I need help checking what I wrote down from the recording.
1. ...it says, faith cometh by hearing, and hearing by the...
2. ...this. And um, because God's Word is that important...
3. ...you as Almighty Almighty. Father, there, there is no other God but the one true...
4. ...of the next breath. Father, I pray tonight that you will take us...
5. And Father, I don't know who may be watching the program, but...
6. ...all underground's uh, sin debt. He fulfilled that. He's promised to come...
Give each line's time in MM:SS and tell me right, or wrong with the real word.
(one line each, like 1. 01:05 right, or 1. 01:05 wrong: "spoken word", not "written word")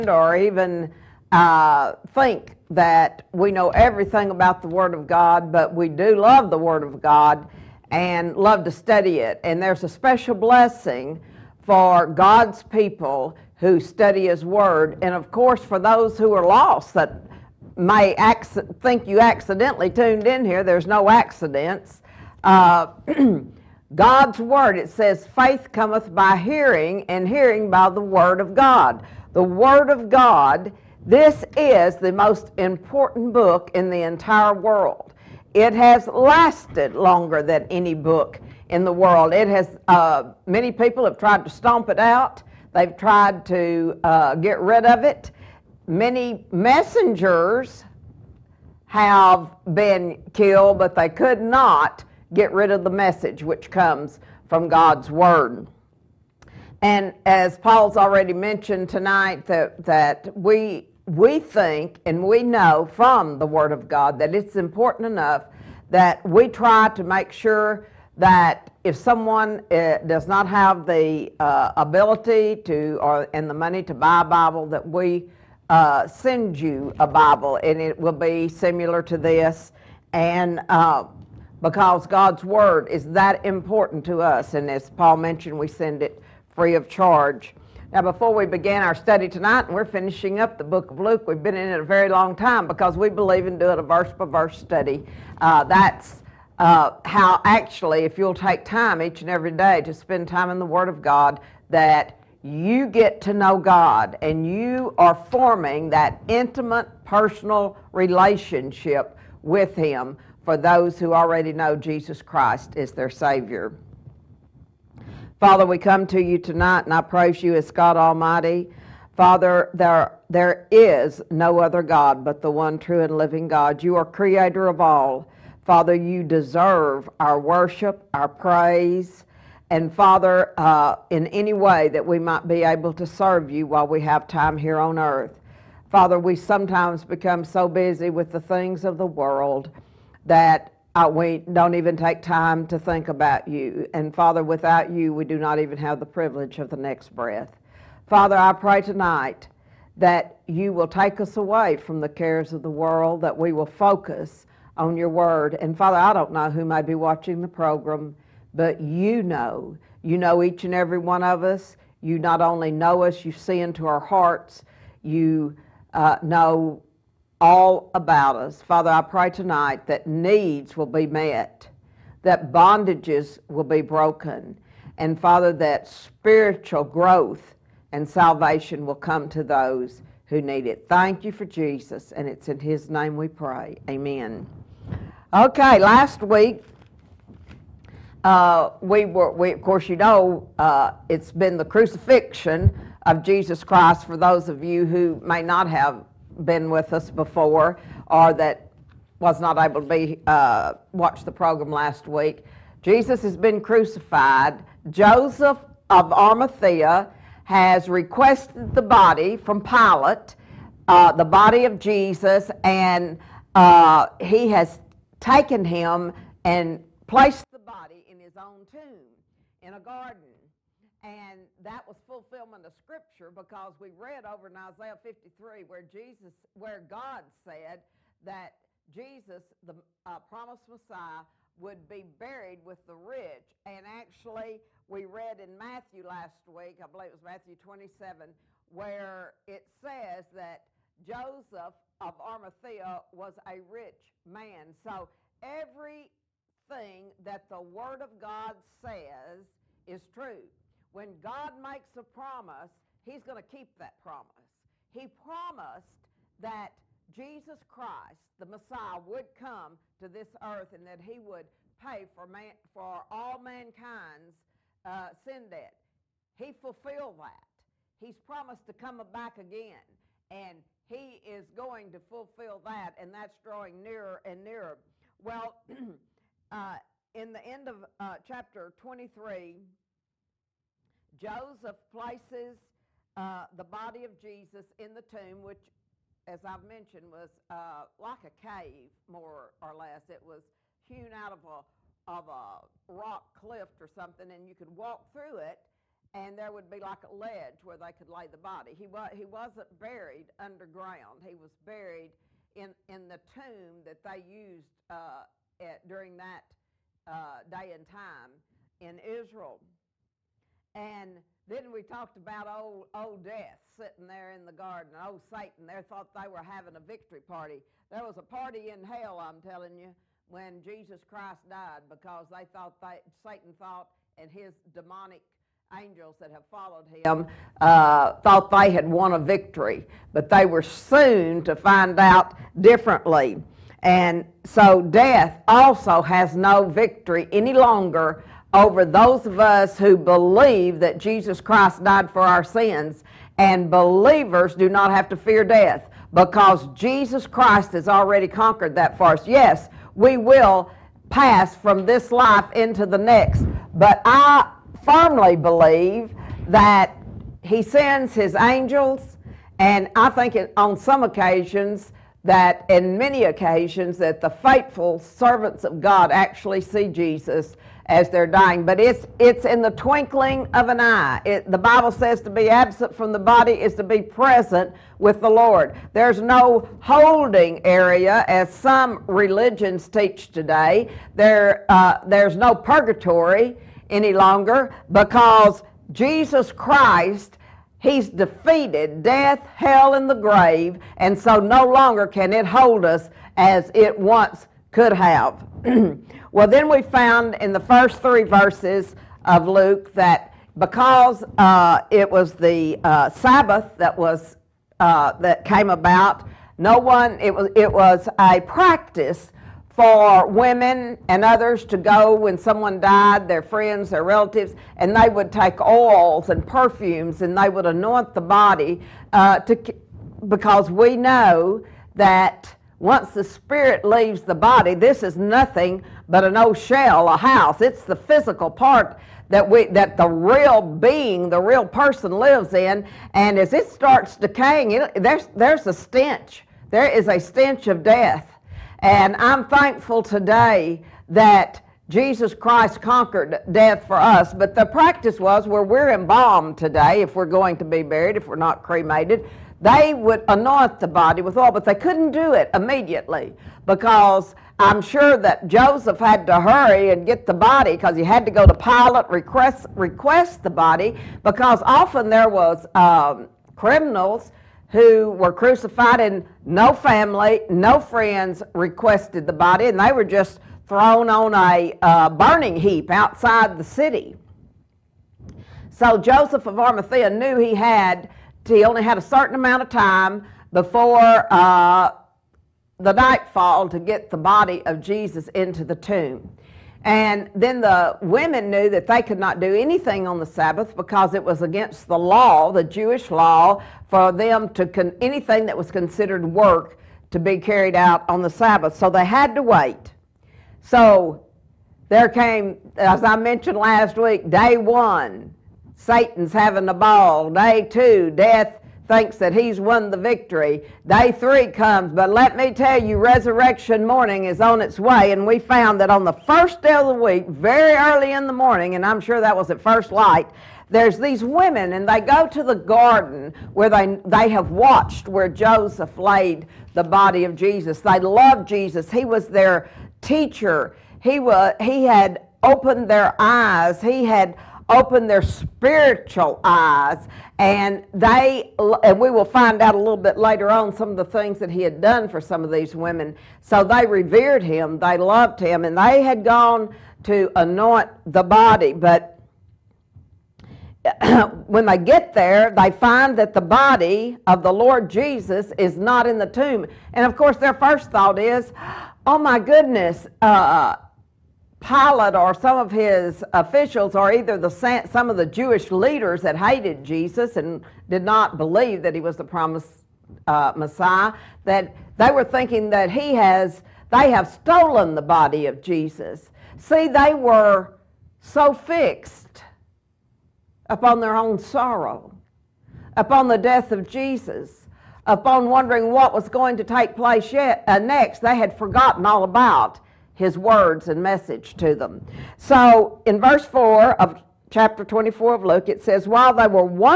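1. 00:24 right
2. 01:19 right
3. 01:57 wrong: "God", not "Almighty"
4. 02:26 right
5. 02:35 right
6. 04:23 wrong: "mankind", not "underground".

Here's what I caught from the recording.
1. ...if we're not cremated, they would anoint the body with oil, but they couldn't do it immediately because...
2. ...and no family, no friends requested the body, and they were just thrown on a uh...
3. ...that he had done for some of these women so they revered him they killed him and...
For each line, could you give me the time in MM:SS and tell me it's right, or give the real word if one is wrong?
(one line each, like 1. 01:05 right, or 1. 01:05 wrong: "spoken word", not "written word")
1. 07:28 right
2. 07:45 right
3. 09:01 wrong: "loved", not "killed".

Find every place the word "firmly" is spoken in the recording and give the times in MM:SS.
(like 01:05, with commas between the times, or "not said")
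05:54.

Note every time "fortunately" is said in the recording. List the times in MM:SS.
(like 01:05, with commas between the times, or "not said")
not said.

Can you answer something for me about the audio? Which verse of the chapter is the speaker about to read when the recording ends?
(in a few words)
verse 4.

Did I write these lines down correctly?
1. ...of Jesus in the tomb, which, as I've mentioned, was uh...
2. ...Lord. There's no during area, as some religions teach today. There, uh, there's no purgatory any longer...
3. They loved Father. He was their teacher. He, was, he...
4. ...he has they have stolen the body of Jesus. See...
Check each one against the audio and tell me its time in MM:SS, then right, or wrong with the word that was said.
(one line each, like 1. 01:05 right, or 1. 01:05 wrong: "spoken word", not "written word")
1. 04:44 right
2. 06:15 wrong: "holding", not "during"
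3. 08:47 wrong: "Jesus", not "Father"
4. 09:32 right.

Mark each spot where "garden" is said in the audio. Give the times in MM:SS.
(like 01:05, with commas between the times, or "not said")
03:39, 05:14, 08:42.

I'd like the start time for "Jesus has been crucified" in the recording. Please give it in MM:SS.
03:22.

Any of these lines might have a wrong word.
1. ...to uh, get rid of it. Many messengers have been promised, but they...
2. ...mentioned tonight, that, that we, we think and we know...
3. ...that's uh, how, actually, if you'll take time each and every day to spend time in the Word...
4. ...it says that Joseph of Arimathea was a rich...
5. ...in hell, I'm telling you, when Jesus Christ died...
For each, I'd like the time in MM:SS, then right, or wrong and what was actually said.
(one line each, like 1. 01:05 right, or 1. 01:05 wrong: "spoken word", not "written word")
1. 00:43 wrong: "killed", not "promised"
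2. 00:58 right
3. 01:35 right
4. 03:59 right
5. 05:18 right.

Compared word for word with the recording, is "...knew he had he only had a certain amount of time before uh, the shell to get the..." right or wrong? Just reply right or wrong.
wrong.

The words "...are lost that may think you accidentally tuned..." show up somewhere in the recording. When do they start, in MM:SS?
00:16.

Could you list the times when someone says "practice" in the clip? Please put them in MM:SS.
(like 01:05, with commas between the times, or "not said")
06:48, 07:24.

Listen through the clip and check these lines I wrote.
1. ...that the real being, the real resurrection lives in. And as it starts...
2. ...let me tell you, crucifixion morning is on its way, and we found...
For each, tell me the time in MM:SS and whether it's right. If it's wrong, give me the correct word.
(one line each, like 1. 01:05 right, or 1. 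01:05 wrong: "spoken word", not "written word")
1. 07:09 wrong: "person", not "resurrection"
2. 08:32 wrong: "resurrection", not "crucifixion".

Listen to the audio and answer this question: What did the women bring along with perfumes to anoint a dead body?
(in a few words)
oils.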